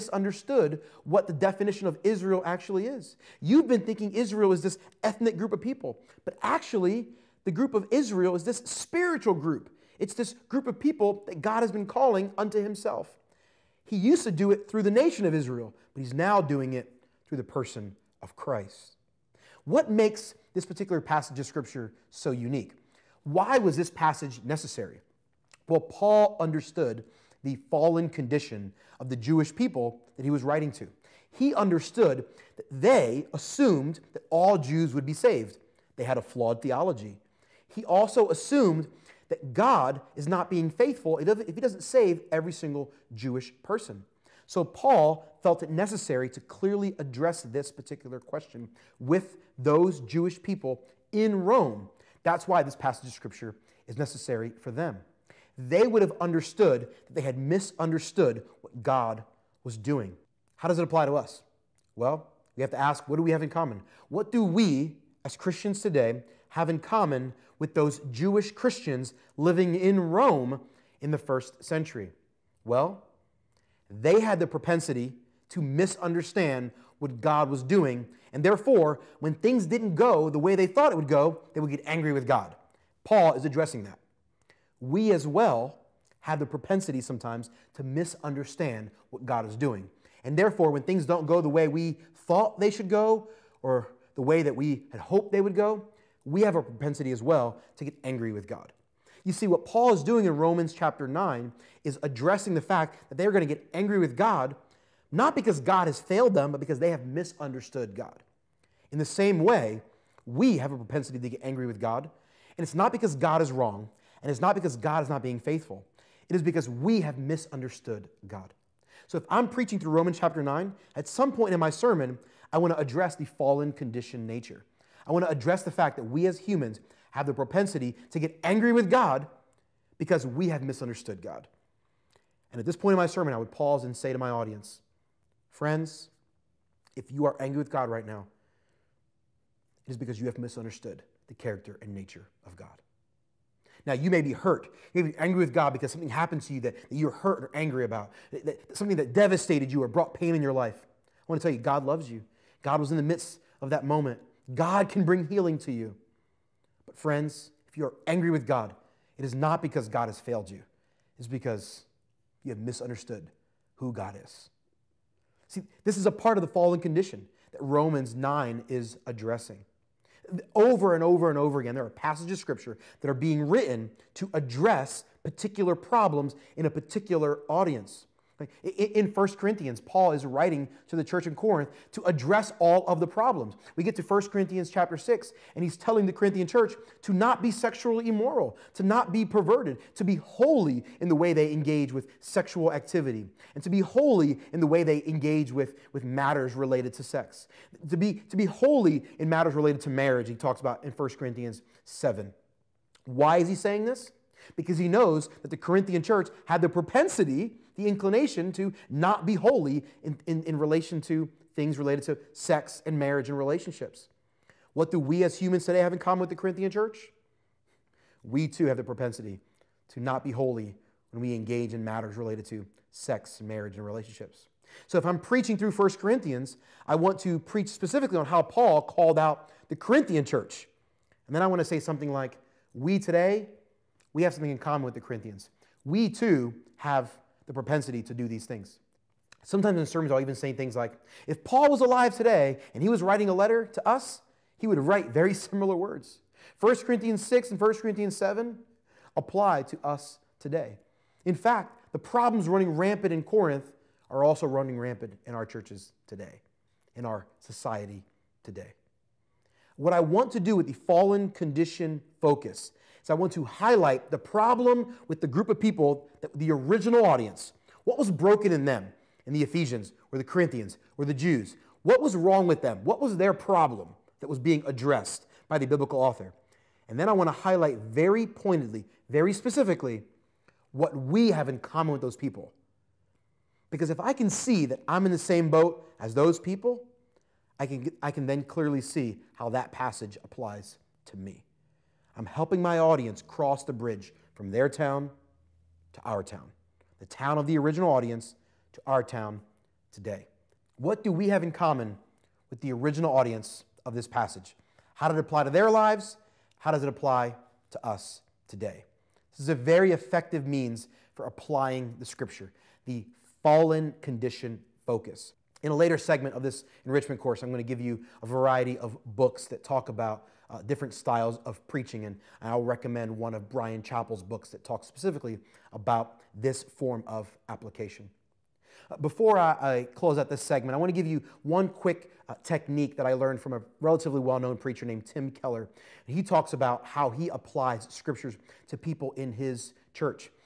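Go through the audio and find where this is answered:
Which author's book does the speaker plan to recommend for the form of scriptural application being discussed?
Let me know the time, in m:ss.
5:23.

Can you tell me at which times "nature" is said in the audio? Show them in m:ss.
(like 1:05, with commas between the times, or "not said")
2:04, 2:21.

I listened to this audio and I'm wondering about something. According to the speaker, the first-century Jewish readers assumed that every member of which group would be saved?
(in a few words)
All Jews.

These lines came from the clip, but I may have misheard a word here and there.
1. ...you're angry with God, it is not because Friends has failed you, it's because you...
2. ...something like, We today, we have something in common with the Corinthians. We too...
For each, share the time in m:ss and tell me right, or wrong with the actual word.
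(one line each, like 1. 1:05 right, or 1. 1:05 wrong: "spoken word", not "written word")
1. 2:37 wrong: "God", not "Friends"
2. 3:51 right.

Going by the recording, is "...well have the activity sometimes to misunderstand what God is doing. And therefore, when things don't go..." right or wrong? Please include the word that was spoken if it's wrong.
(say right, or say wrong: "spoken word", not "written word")
wrong: "propensity", not "activity".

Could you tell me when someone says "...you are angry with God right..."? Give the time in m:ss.
2:17.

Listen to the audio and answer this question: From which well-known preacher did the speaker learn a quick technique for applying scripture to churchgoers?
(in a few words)
Tim Keller.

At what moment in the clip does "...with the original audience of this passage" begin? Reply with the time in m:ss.
5:02.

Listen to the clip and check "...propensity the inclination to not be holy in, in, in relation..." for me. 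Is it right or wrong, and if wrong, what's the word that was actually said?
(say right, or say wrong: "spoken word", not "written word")
right.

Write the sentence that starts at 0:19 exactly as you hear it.
What makes this particular passage of Scripture so unique?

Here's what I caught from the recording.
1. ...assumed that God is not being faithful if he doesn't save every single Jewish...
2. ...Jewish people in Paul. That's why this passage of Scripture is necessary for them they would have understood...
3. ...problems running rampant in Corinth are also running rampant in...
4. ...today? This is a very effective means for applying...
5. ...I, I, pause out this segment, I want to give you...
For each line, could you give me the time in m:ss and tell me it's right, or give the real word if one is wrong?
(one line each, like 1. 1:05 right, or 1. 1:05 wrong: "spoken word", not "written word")
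1. 0:38 right
2. 0:50 wrong: "Rome", not "Paul"
3. 4:11 right
4. 5:08 right
5. 5:29 wrong: "close", not "pause".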